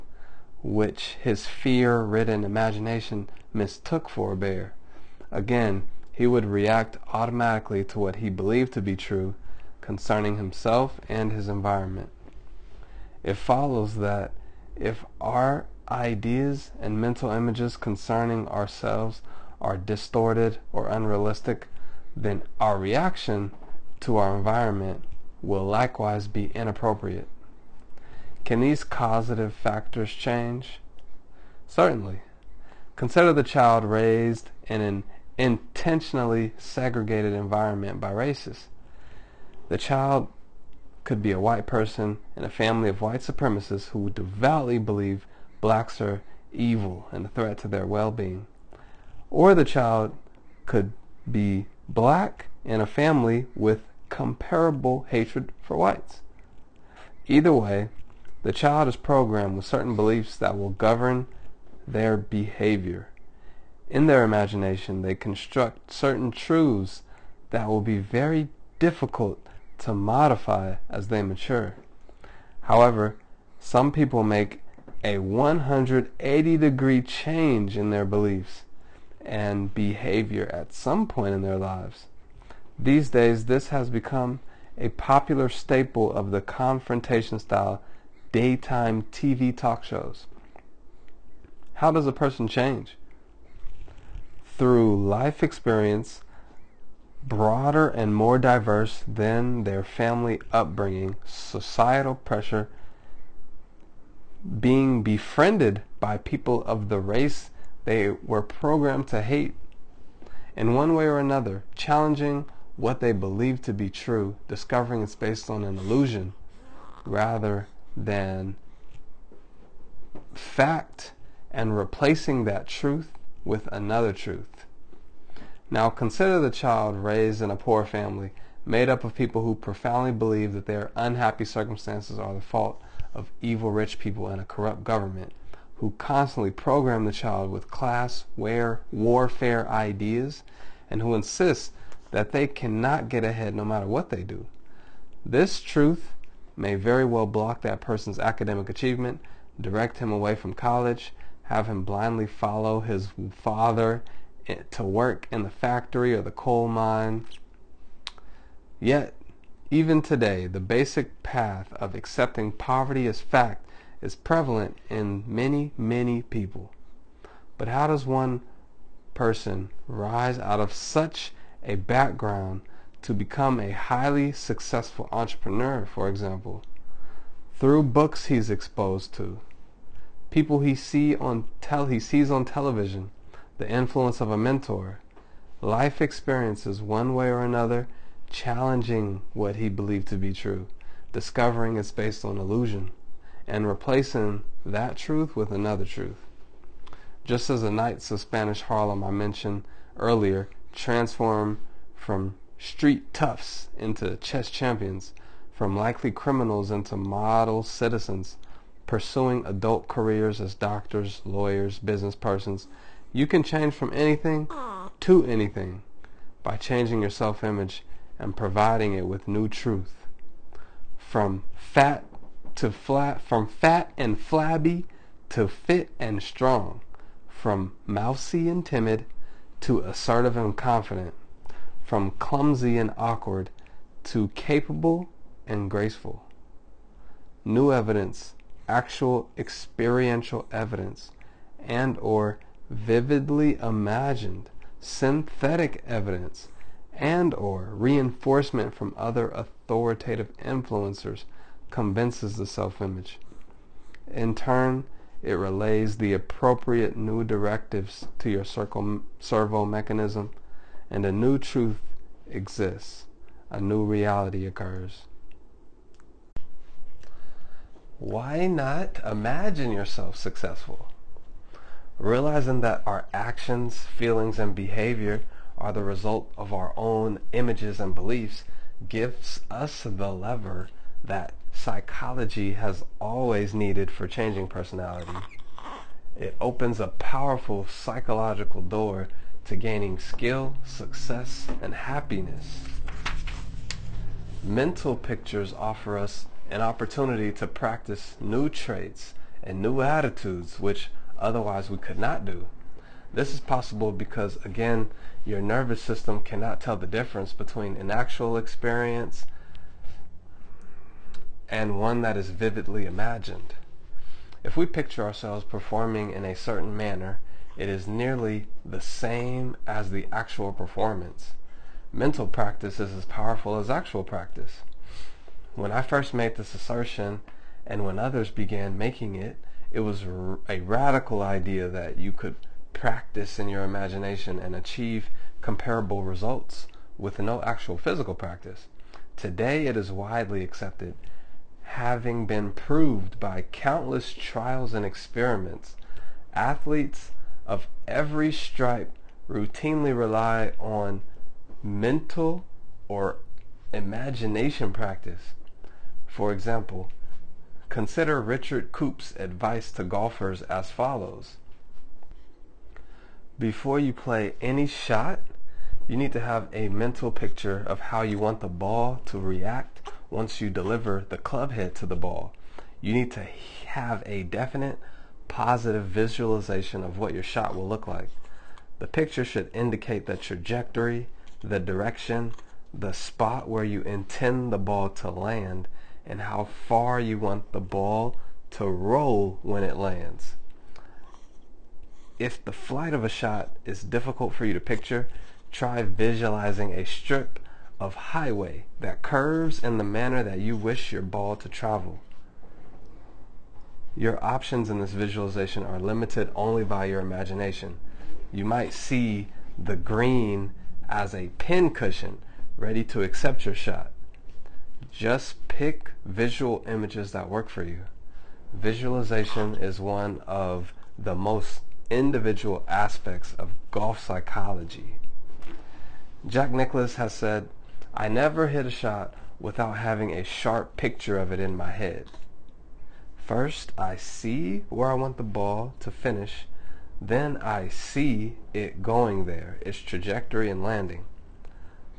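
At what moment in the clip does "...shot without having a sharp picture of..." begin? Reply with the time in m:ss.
7:08.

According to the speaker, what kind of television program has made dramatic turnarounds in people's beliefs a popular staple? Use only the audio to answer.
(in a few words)
daytime TV talk shows.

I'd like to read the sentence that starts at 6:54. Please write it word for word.
Just pick visual images that work for you.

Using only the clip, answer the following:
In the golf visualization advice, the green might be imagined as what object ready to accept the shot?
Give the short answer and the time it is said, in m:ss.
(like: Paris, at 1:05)
a pin cushion, at 6:51.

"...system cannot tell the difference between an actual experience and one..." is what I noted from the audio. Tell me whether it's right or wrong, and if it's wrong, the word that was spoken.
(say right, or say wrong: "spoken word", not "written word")
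right.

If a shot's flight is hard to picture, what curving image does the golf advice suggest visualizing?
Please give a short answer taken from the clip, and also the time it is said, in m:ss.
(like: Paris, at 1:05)
a strip of highway, at 6:36.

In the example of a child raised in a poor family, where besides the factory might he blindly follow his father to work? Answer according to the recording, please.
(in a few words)
the coal mine.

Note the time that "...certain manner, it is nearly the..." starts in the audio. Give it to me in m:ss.
5:16.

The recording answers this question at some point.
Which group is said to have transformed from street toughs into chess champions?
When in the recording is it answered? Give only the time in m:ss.
3:17.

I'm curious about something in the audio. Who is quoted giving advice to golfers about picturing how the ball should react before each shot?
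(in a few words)
Richard Coop.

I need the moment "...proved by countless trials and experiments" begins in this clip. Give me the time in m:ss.
5:42.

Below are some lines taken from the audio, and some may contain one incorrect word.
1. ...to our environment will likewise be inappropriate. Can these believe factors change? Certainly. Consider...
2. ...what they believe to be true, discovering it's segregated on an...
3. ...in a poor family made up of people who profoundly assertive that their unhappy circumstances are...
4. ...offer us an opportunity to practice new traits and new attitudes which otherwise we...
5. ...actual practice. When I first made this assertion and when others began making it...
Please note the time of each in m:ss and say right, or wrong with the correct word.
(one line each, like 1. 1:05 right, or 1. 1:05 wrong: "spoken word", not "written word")
1. 0:23 wrong: "causative", not "believe"
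2. 1:52 wrong: "based", not "segregated"
3. 2:07 wrong: "believe", not "assertive"
4. 4:55 right
5. 5:23 right.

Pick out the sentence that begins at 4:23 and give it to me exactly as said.
A new reality occurs why not imagine yourself successful?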